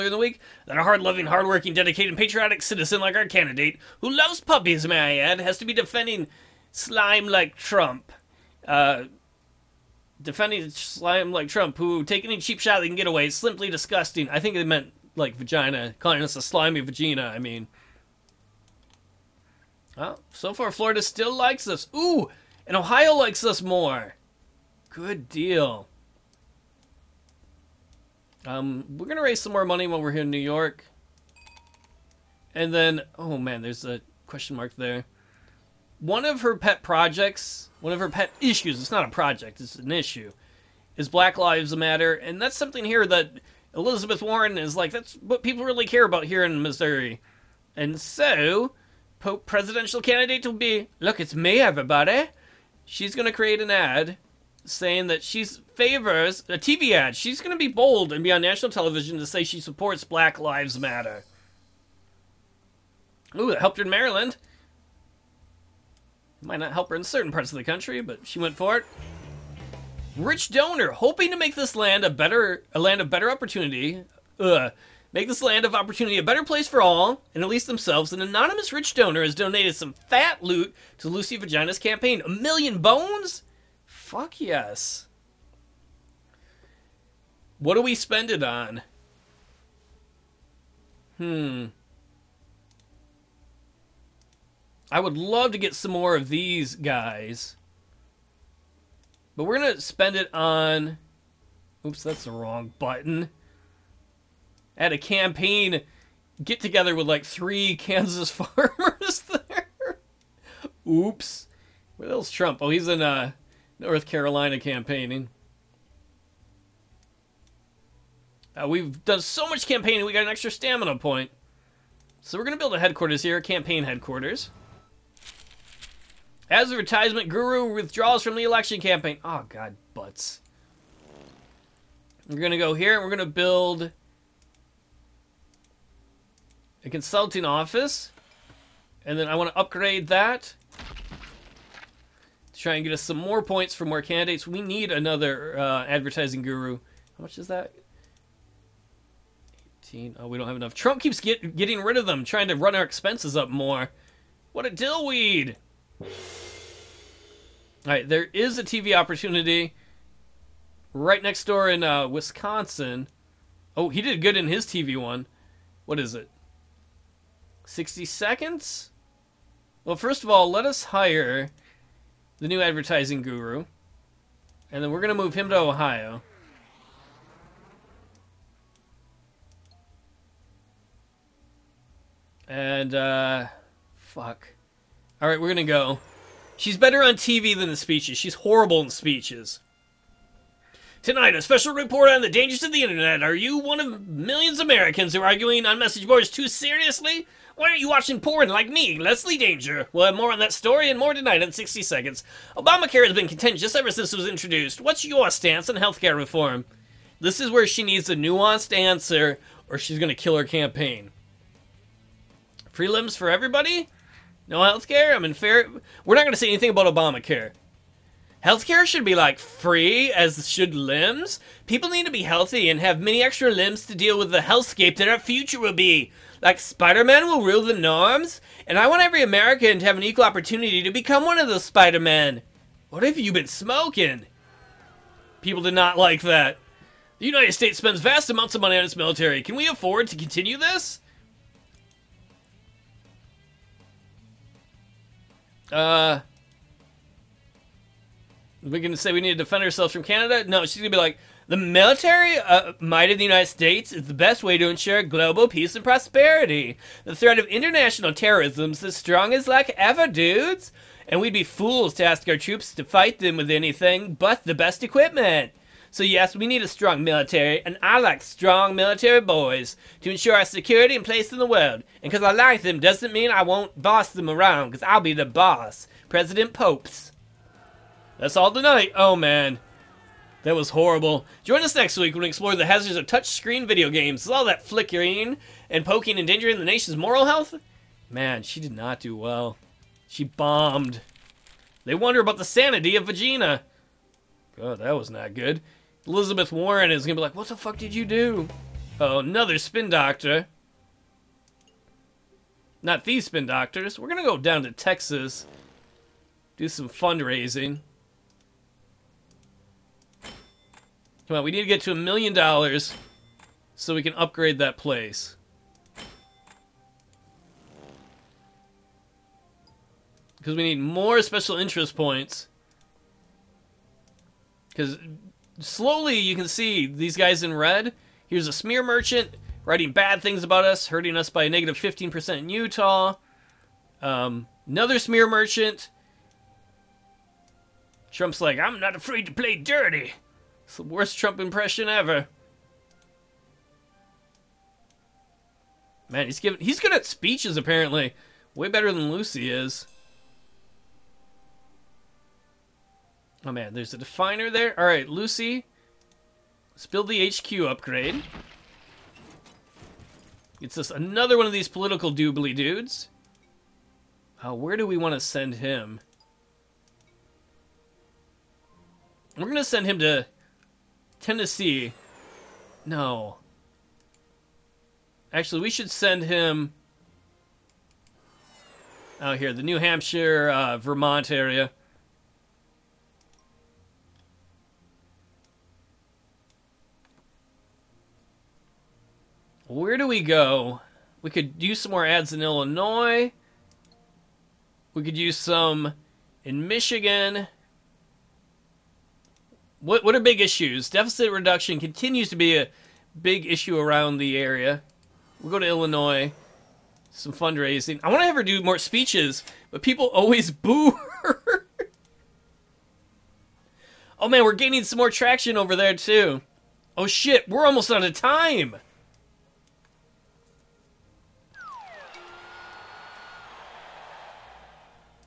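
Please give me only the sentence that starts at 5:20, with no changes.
Because we need more special interest points.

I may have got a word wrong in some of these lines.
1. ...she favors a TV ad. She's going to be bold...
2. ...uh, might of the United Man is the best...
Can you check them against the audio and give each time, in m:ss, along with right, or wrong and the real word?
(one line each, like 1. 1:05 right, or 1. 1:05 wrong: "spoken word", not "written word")
1. 0:55 right
2. 4:12 wrong: "States", not "Man".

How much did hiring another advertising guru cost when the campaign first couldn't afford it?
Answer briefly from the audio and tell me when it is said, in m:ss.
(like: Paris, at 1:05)
18, at 2:29.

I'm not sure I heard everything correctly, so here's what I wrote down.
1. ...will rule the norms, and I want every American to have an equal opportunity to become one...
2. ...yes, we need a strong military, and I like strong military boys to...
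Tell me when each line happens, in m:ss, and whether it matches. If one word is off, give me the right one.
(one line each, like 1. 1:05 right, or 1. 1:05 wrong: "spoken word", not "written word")
1. 3:47 right
2. 4:26 right.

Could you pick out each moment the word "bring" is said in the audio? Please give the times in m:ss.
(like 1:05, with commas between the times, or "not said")
not said.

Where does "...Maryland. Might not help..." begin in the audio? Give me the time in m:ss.
1:03.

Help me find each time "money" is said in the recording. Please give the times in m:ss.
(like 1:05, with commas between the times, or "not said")
0:29, 3:58.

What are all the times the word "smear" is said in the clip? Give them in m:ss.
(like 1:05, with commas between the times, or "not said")
5:28, 5:34.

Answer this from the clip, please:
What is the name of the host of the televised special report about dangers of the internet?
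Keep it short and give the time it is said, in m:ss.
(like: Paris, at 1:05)
Leslie Danger, at 3:18.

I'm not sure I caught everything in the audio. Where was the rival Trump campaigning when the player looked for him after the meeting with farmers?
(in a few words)
North Carolina.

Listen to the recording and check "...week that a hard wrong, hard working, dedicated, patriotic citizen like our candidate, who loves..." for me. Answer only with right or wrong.
wrong.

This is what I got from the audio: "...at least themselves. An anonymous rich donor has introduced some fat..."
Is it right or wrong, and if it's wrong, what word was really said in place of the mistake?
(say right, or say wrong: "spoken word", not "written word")
wrong: "donated", not "introduced".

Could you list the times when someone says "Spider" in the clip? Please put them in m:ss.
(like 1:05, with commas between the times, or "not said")
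3:46, 3:51.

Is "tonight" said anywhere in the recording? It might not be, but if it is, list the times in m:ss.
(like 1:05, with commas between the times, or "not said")
3:11, 3:21, 4:38.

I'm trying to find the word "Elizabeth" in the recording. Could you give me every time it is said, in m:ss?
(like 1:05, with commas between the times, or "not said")
0:43, 4:56.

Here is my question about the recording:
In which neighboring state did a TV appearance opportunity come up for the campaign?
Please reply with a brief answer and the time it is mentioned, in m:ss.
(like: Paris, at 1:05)
Wisconsin, at 2:42.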